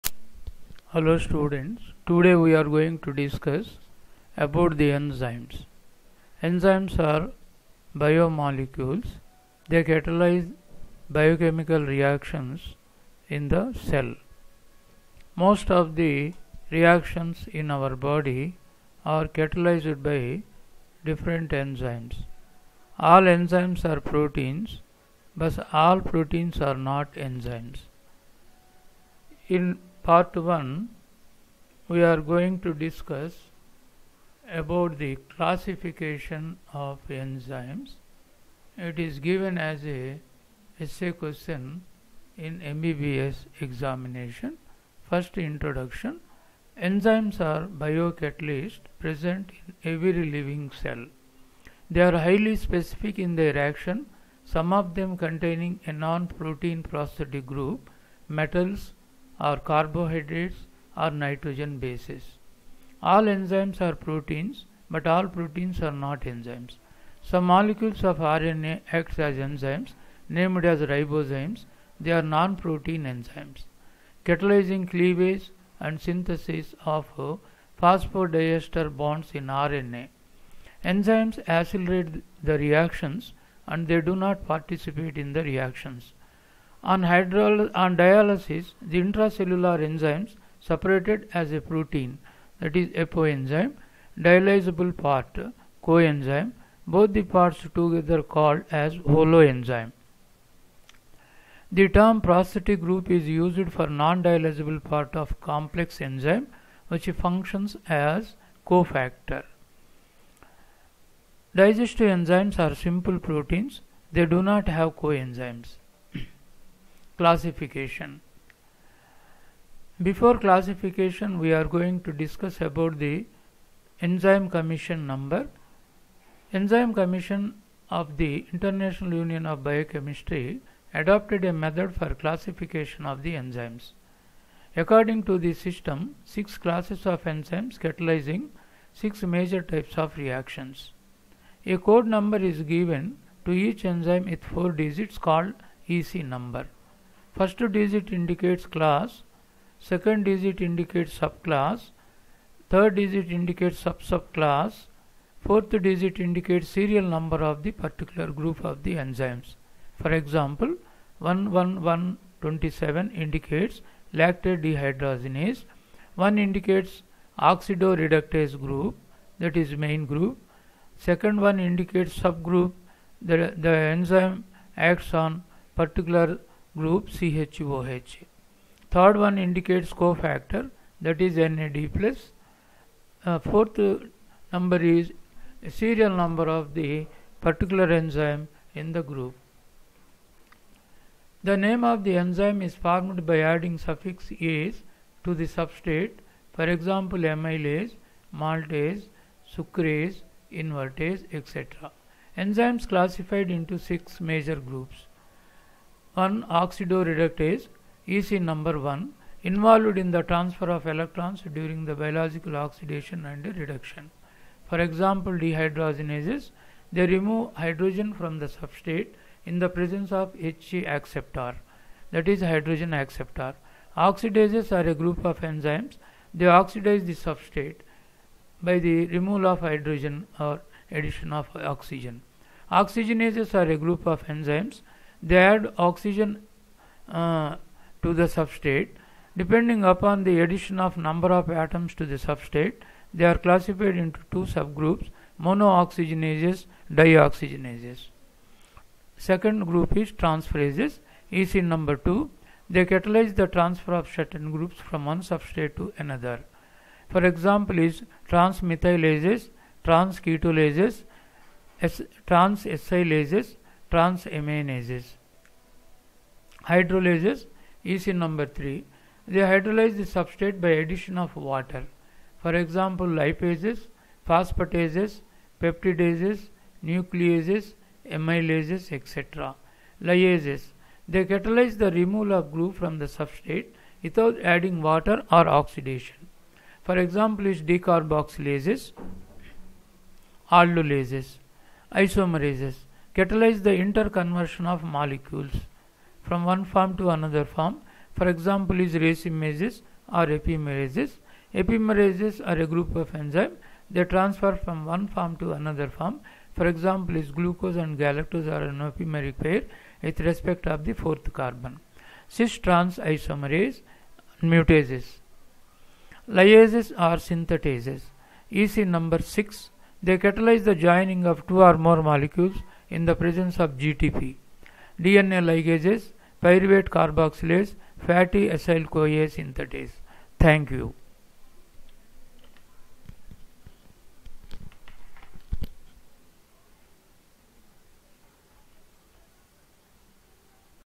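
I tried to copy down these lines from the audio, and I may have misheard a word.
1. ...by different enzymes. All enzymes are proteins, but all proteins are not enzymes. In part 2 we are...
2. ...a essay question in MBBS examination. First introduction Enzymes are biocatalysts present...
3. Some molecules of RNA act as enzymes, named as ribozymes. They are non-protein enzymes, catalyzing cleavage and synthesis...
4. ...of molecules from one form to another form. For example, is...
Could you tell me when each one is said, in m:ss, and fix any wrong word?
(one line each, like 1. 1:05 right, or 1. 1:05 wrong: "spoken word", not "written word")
1. 0:20 wrong: "1", not "2"
2. 0:39 right
3. 1:07 right
4. 4:54 right.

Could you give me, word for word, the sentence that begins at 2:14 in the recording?
According to the system, six classes of enzymes catalyzing six major types of reactions.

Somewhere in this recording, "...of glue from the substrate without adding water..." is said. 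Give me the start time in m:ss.
4:42.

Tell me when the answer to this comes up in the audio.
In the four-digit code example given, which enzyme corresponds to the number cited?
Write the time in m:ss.
2:44.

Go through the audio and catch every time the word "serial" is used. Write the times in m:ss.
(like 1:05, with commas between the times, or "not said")
2:36, 3:05.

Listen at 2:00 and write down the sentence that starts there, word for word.
Before classification we are going to discuss about the enzyme commission number.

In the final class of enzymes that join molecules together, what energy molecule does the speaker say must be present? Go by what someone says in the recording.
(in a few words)
GTP.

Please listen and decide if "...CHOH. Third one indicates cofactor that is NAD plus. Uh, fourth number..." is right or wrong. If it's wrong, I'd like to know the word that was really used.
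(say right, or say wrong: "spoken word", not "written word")
right.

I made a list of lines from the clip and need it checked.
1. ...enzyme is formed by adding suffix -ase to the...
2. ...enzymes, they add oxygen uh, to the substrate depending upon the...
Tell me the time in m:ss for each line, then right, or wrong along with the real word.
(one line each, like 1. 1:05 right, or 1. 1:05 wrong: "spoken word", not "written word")
1. 3:12 right
2. 3:54 right.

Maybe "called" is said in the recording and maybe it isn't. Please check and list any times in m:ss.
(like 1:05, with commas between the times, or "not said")
1:38, 2:25.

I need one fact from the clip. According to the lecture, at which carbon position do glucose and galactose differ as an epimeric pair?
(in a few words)
fourth carbon.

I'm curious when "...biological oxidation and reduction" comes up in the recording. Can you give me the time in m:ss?
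3:31.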